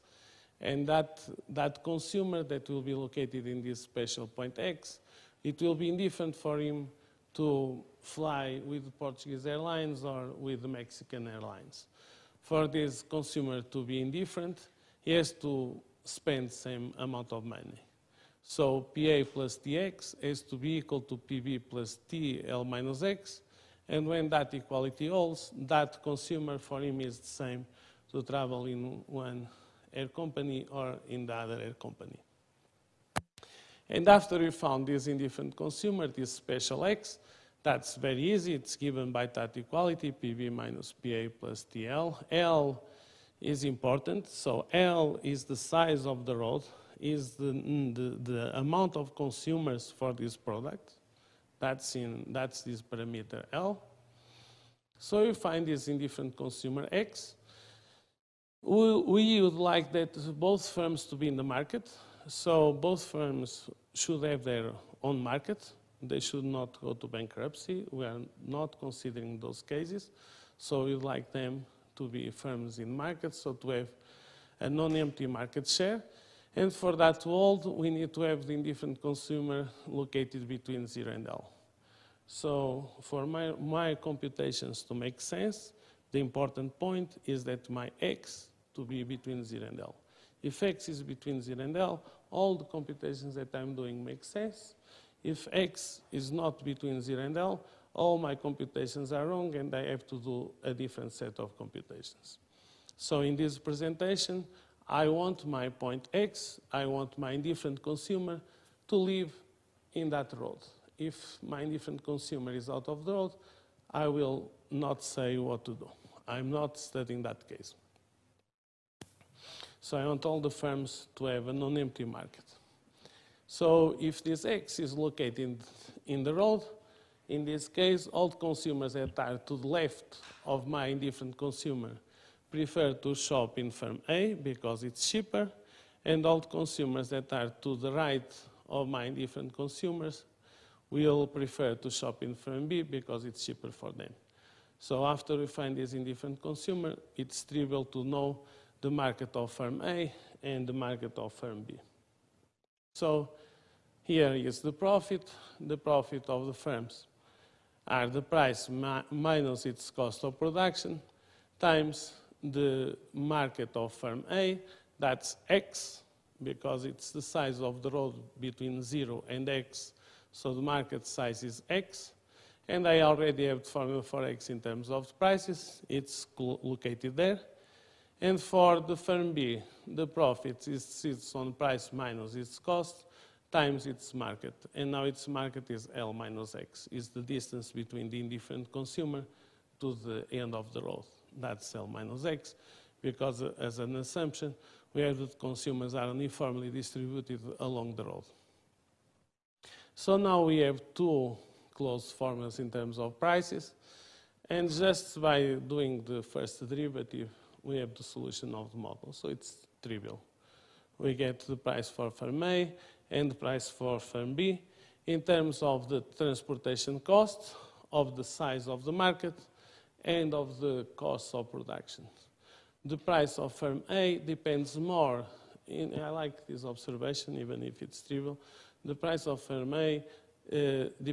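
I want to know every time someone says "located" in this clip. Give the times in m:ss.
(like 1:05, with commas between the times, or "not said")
0:02, 1:19, 2:04, 2:56.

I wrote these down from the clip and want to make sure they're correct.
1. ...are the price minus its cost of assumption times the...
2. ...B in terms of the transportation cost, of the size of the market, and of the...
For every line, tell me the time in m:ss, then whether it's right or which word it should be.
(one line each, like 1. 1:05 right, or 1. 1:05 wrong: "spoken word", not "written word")
1. 2:37 wrong: "production", not "assumption"
2. 3:34 right.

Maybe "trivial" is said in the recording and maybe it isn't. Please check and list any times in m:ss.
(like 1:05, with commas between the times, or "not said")
2:27, 3:29, 3:48.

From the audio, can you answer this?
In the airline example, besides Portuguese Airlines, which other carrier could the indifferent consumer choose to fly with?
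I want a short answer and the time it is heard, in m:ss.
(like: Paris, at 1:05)
Mexican Airlines, at 0:10.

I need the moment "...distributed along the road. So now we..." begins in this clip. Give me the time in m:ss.
3:16.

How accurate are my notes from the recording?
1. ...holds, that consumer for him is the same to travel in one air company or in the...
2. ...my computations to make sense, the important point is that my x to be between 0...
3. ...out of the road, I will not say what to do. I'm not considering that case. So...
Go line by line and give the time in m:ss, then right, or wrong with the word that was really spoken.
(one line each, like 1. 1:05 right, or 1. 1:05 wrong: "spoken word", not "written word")
1. 0:25 right
2. 1:23 right
3. 1:52 wrong: "studying", not "considering".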